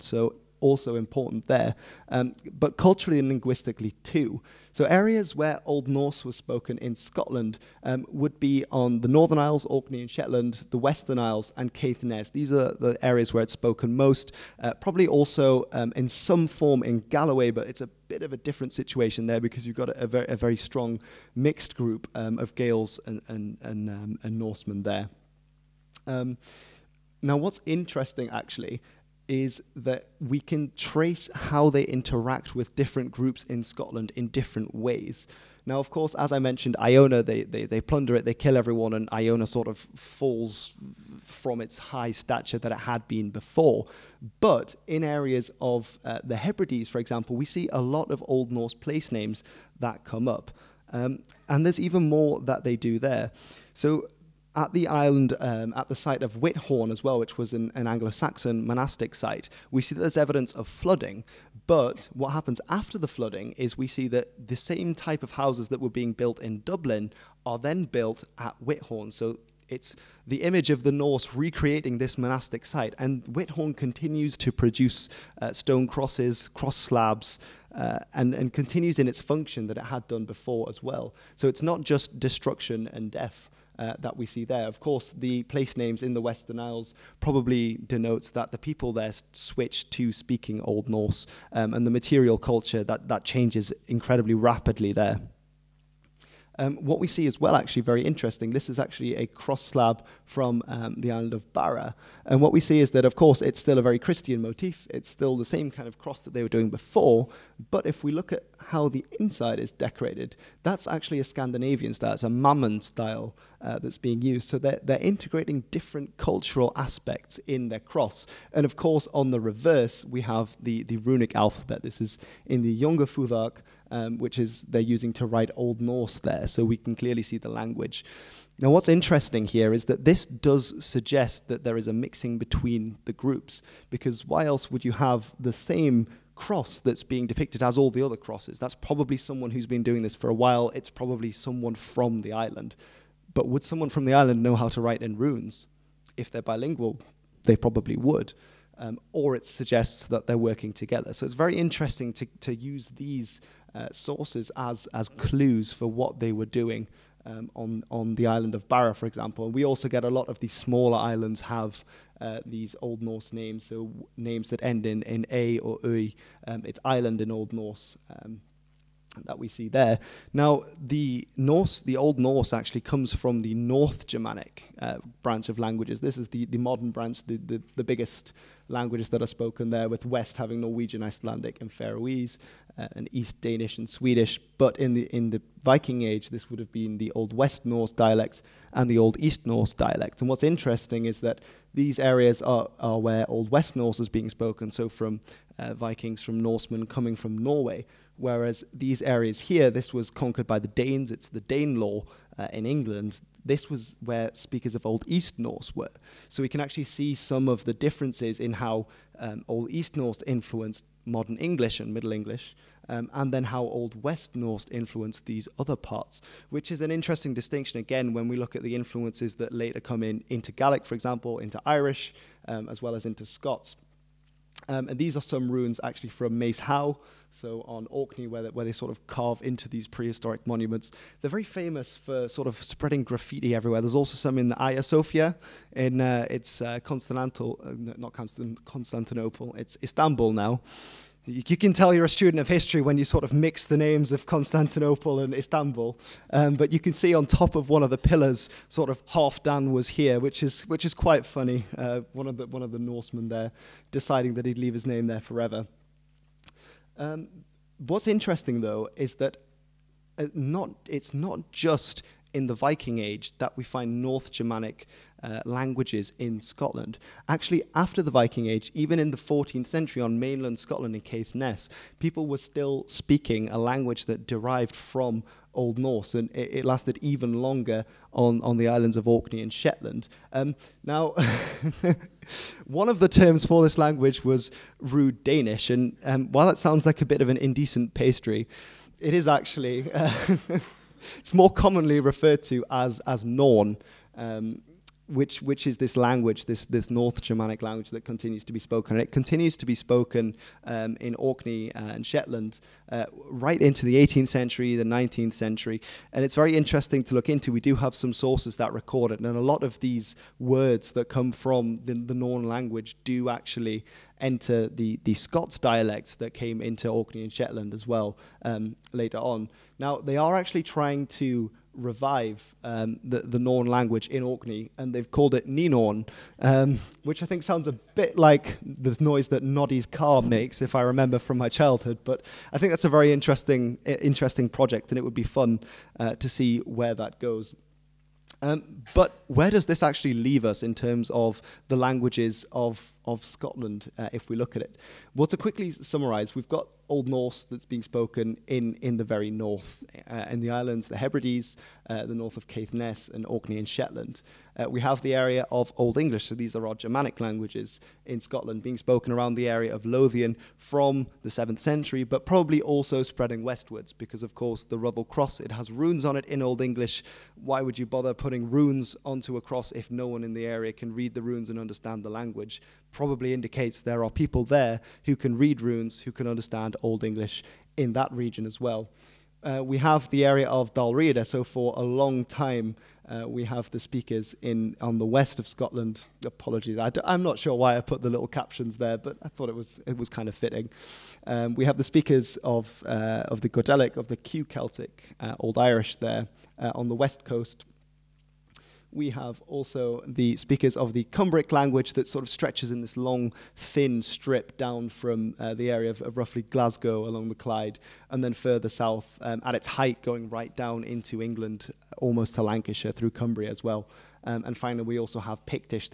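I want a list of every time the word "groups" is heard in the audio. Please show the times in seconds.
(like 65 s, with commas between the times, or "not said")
21 s, 33 s, 133 s.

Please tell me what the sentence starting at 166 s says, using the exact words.
Um, it's island in Old Norse.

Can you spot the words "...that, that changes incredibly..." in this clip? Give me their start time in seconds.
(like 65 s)
92 s.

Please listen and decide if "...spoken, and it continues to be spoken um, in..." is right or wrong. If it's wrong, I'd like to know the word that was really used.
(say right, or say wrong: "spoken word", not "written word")
right.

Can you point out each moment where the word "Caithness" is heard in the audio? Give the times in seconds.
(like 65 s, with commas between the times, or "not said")
11 s, 271 s, 352 s.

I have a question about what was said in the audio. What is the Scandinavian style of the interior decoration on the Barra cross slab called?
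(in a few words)
Mammen style.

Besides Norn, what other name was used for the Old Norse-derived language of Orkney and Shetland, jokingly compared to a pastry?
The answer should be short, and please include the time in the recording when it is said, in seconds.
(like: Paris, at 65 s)
Rude Danish, at 284 s.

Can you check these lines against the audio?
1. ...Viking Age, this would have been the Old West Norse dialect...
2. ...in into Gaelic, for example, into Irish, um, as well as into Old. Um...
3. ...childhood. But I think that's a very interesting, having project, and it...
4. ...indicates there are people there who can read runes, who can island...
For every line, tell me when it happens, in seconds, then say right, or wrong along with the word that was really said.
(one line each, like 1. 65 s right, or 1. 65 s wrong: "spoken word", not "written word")
1. 185 s right
2. 220 s wrong: "Scots", not "Old"
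3. 331 s wrong: "interesting", not "having"
4. 373 s wrong: "understand", not "island".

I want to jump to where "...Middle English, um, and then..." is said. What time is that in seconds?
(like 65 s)
211 s.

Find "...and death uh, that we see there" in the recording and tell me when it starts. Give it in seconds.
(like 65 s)
82 s.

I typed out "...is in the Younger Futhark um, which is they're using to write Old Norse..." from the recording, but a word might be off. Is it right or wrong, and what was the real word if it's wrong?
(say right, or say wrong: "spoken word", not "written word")
right.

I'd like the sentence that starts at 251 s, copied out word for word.
Uh, one of the one of the Norsemen there deciding that he'd leave his name there forever.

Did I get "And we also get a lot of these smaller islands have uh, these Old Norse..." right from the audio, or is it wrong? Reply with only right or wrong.
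right.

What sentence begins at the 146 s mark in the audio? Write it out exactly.
If they're bilingual, they probably would.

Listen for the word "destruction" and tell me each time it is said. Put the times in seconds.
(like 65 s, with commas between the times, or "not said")
82 s.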